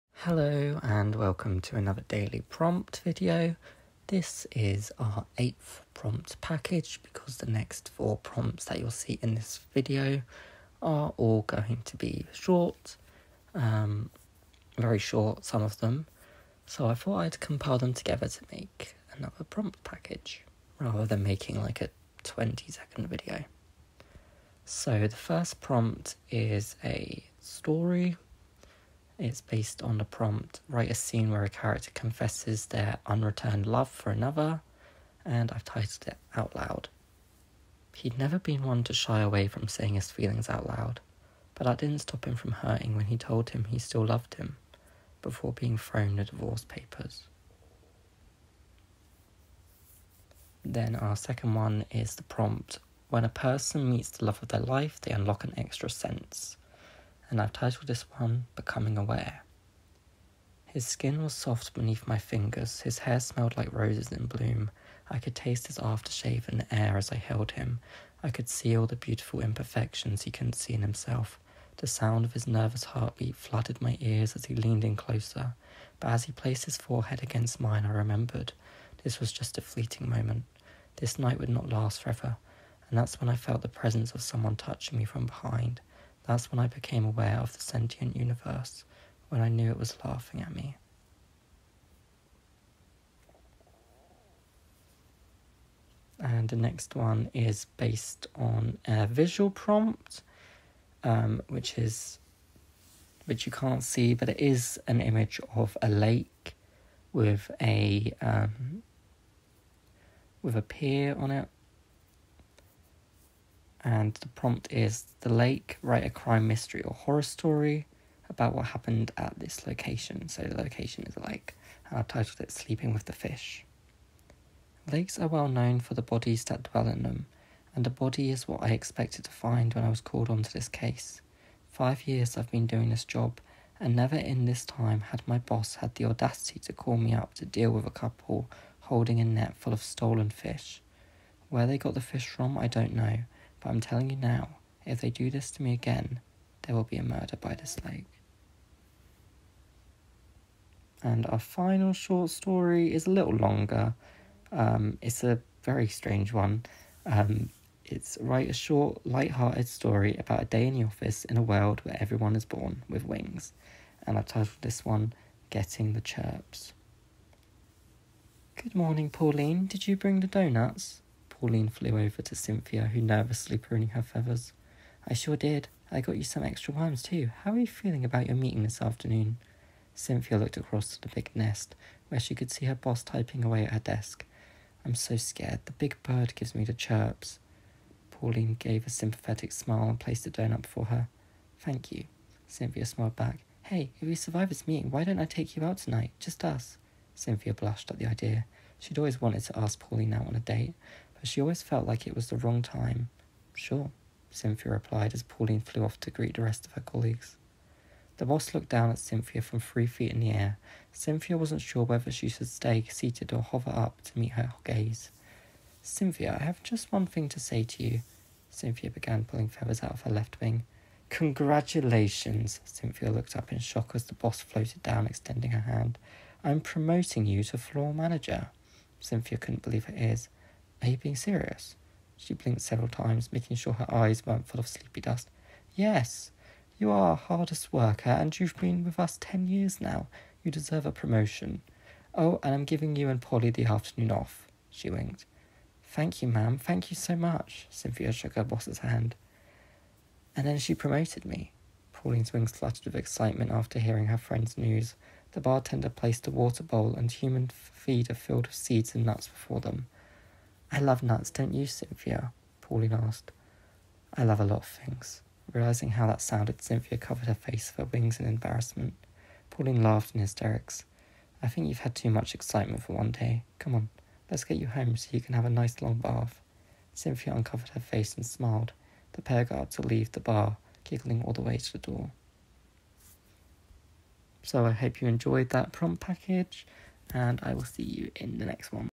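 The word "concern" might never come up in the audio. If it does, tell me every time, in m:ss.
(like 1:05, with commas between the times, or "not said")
not said.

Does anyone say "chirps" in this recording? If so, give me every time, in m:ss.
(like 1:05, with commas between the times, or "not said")
2:46, 3:06.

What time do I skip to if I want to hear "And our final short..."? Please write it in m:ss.
2:31.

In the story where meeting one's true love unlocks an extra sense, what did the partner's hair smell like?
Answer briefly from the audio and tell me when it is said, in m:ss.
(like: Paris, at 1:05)
Roses in bloom, at 1:03.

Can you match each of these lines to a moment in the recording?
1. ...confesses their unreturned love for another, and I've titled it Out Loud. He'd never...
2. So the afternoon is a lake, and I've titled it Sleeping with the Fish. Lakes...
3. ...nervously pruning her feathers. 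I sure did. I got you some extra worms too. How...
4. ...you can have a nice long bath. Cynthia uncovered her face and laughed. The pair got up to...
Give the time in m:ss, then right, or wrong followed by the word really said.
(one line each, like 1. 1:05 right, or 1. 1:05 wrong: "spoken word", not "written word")
1. 0:31 right
2. 2:00 wrong: "location", not "afternoon"
3. 2:53 right
4. 4:35 wrong: "smiled", not "laughed".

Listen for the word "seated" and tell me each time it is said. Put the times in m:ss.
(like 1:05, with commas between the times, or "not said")
3:32.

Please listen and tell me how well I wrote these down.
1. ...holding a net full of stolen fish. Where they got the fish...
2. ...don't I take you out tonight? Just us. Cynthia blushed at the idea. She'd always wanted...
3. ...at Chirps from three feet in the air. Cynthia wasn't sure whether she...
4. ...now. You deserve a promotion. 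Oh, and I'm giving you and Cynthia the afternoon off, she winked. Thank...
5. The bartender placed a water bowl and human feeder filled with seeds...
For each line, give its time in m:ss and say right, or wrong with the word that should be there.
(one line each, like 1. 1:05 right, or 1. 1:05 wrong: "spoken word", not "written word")
1. 2:18 right
2. 3:15 right
3. 3:28 wrong: "Cynthia", not "Chirps"
4. 3:59 wrong: "Polly", not "Cynthia"
5. 4:15 right.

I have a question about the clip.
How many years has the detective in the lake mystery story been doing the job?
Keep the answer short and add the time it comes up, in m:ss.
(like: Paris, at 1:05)
5, at 2:11.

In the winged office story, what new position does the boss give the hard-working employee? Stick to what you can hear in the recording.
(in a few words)
Floor manager.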